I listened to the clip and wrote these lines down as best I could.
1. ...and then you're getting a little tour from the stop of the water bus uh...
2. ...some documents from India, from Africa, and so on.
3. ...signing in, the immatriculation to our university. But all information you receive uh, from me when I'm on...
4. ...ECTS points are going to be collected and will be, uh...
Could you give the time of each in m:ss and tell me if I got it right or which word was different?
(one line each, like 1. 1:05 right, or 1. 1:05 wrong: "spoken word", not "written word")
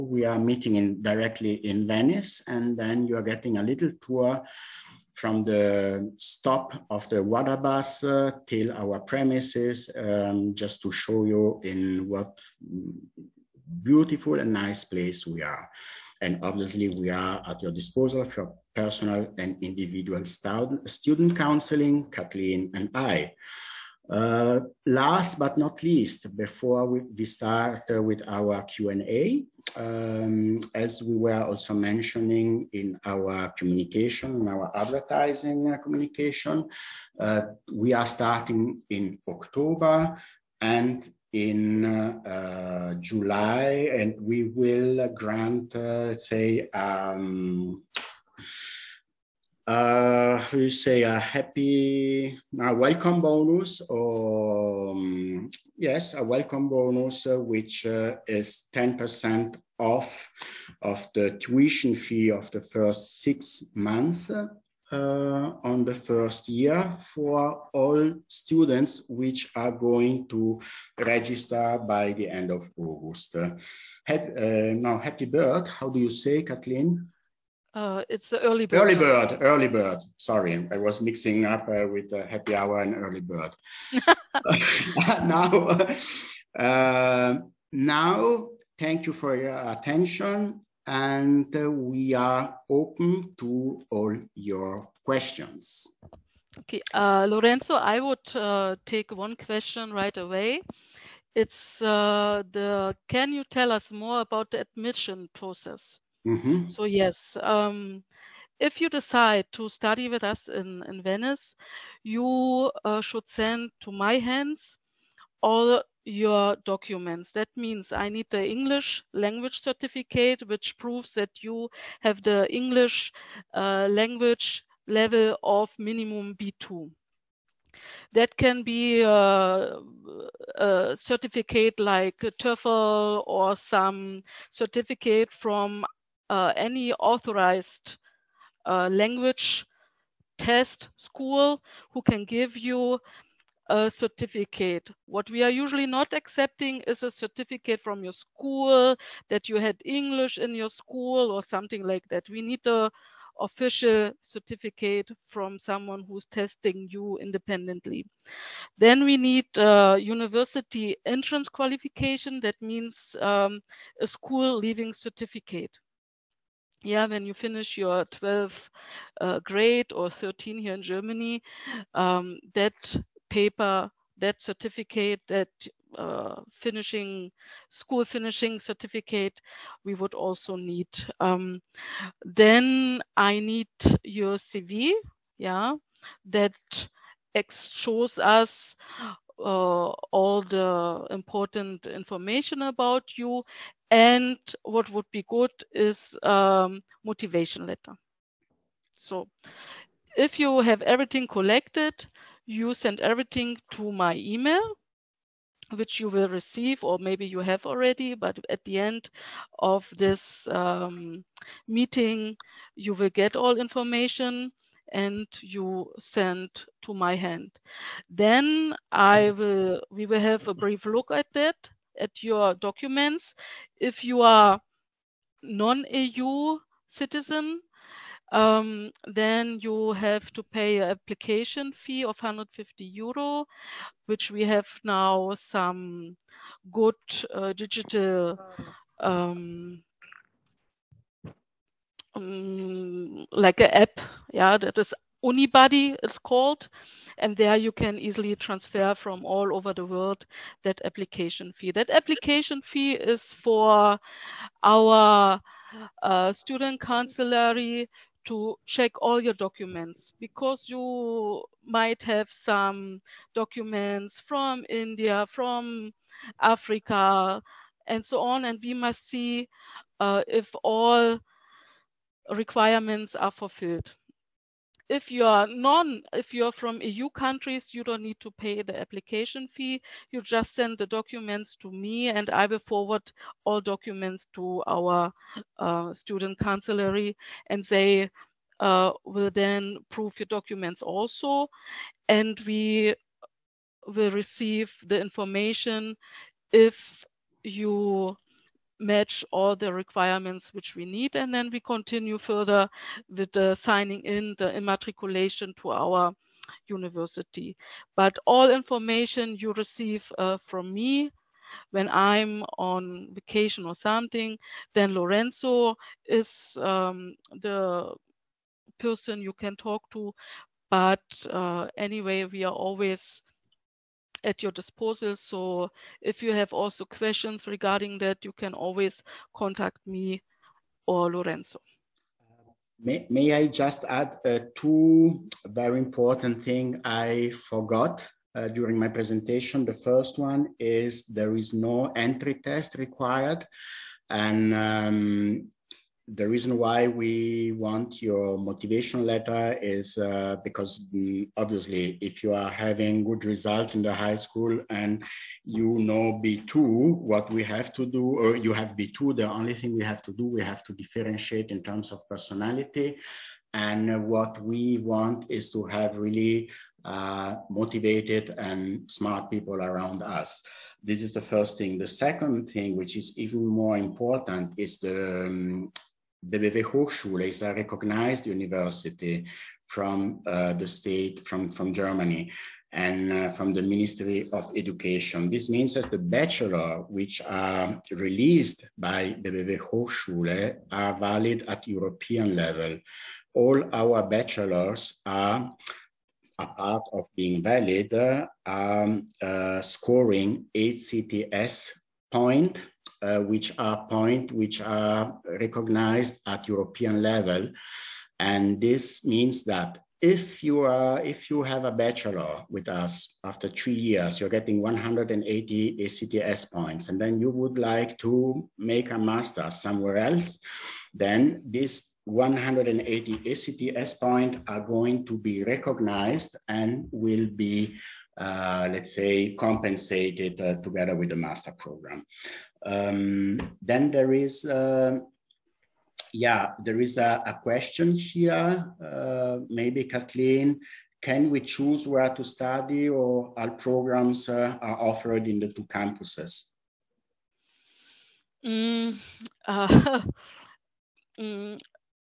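1. 0:02 right
2. 4:22 right
3. 5:03 right
4. 7:03 wrong: "recognized", not "collected".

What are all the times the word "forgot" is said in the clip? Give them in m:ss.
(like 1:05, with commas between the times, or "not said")
5:37.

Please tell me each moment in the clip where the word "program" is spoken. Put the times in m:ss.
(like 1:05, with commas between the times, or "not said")
7:11, 7:23.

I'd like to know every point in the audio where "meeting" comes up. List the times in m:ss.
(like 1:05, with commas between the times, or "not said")
0:00, 3:31.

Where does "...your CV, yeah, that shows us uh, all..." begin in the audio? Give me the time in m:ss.
3:04.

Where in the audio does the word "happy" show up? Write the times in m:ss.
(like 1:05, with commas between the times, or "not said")
0:51, 1:14, 1:22.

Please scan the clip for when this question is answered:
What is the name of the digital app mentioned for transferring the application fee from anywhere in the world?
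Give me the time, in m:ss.
4:05.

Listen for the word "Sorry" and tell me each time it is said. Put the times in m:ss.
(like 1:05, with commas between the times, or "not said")
1:20.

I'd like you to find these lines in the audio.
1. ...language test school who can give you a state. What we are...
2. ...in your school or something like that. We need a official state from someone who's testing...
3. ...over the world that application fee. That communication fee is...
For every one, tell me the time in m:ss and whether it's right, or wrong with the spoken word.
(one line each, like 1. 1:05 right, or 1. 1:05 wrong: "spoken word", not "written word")
1. 2:18 wrong: "certificate", not "state"
2. 2:30 wrong: "certificate", not "state"
3. 4:09 wrong: "application", not "communication".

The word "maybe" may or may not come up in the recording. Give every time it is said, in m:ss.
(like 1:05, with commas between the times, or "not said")
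3:26, 7:19.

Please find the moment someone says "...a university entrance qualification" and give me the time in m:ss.
2:39.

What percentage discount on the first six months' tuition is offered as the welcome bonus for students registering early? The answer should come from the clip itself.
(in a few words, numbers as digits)
10%.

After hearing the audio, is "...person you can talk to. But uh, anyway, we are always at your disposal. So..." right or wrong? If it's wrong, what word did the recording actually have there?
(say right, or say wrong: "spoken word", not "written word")
right.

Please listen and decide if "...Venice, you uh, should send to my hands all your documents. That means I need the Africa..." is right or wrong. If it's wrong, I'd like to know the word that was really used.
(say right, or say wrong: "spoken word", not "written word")
wrong: "English", not "Africa".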